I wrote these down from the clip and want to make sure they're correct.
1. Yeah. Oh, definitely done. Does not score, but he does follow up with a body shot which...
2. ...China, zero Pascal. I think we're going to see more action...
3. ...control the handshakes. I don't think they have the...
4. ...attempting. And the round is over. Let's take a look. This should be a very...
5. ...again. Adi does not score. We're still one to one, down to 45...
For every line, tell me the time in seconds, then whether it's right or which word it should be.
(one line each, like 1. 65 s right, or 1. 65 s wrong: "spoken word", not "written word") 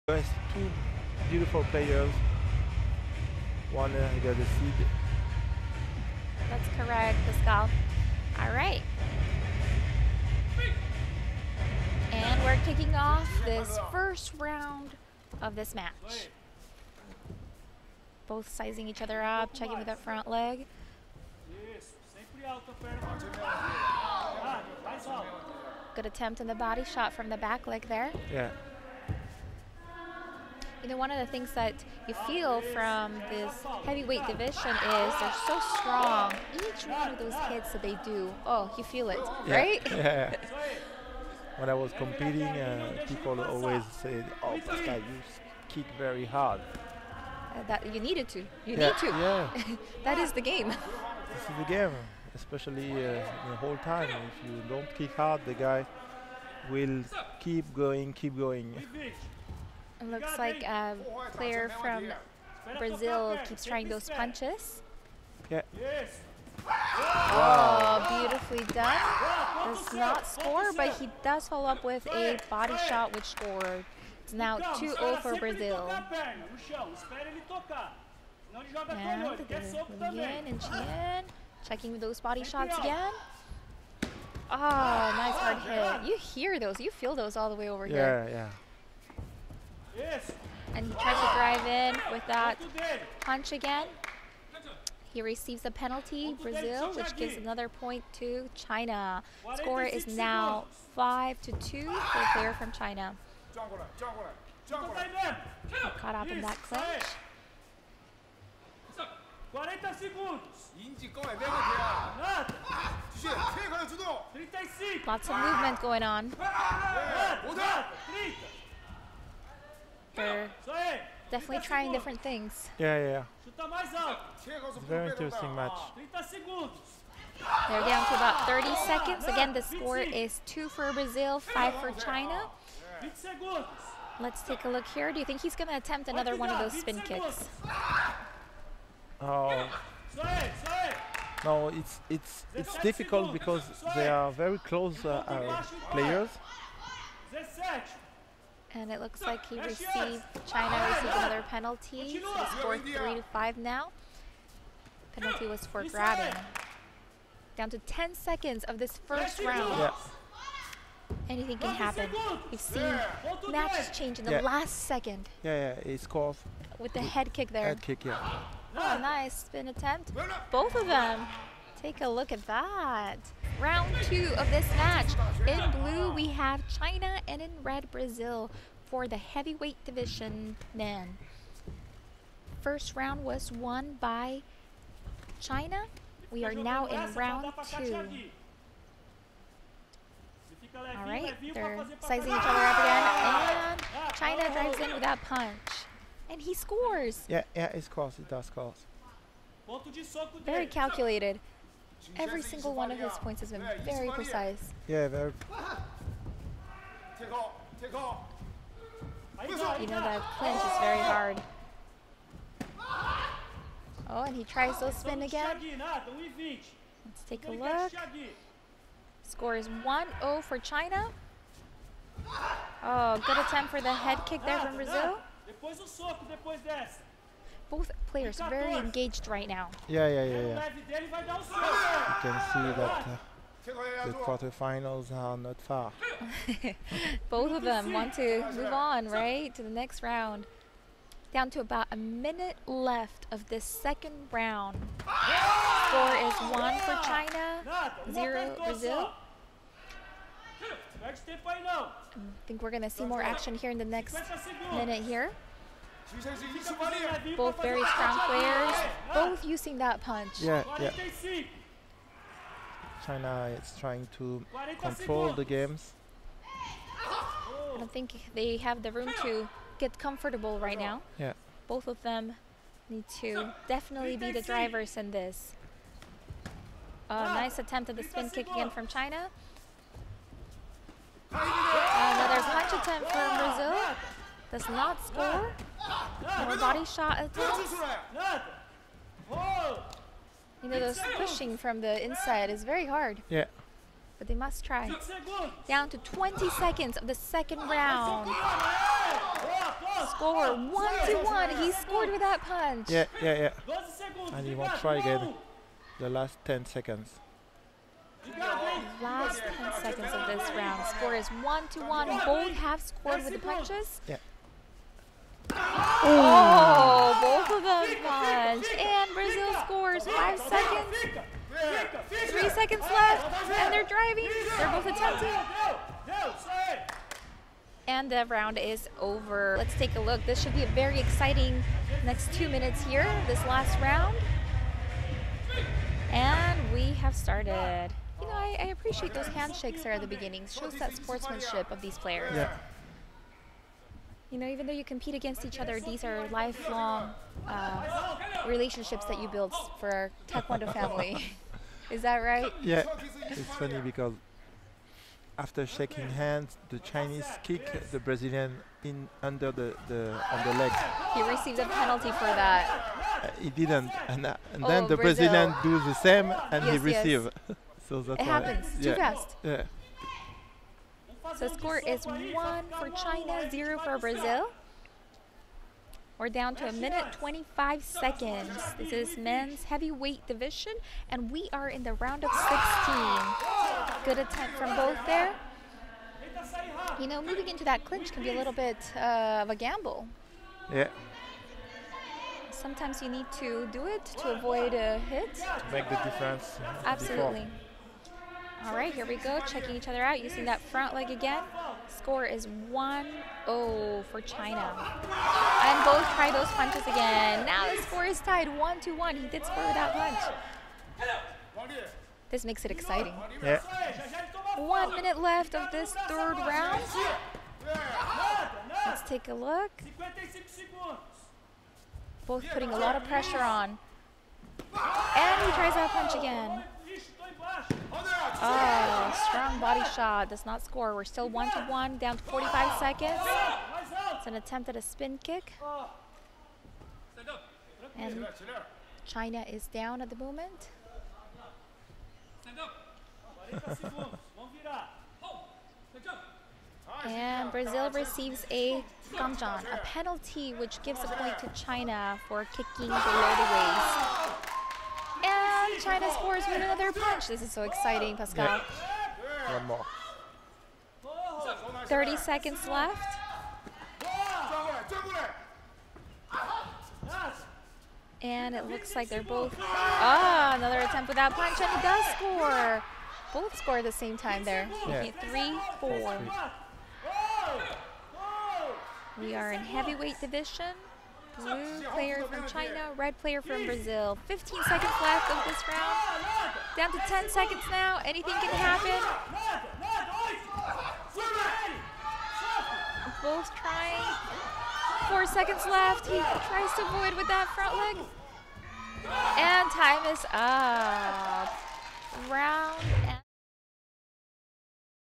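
1. 65 s wrong: "beautifully", not "definitely"
2. 247 s wrong: "Brazil", not "Pascal"
3. 264 s wrong: "games", not "handshakes"
4. 324 s right
5. 426 s right.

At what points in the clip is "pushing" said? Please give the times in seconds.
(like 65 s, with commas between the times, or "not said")
291 s.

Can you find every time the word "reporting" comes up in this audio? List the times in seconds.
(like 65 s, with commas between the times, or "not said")
not said.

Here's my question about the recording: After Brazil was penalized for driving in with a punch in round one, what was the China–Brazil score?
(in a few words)
5 to 2.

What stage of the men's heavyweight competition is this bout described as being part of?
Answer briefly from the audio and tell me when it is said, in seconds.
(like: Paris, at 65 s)
Round of 16, at 384 s.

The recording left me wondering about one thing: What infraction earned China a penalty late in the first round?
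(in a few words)
Grabbing.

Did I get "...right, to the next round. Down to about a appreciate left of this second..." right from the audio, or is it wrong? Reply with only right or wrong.
wrong.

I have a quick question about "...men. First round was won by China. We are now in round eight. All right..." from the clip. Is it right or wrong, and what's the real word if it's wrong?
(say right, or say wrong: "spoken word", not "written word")
wrong: "two", not "eight".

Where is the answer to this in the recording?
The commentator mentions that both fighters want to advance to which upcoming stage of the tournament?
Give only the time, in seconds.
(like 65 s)
234 s.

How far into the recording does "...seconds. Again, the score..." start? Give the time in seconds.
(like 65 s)
128 s.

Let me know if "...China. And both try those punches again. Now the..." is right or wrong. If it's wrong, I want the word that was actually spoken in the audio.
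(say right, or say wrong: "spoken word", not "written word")
right.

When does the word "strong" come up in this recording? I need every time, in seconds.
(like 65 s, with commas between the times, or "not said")
35 s, 257 s.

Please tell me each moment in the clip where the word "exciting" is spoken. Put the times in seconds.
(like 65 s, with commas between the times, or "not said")
330 s, 412 s, 457 s.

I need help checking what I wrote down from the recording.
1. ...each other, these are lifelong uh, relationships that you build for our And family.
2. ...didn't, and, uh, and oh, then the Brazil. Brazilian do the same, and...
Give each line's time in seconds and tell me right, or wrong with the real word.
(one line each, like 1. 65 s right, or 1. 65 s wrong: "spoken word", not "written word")
1. 345 s wrong: "Taekwondo", not "And"
2. 363 s right.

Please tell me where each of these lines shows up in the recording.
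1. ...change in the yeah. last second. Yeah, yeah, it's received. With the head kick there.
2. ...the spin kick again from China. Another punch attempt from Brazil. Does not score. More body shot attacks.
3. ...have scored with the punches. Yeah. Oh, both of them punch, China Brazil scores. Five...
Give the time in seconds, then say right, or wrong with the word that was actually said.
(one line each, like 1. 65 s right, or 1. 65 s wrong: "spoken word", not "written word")
1. 163 s wrong: "called", not "received"
2. 277 s right
3. 312 s wrong: "And", not "China".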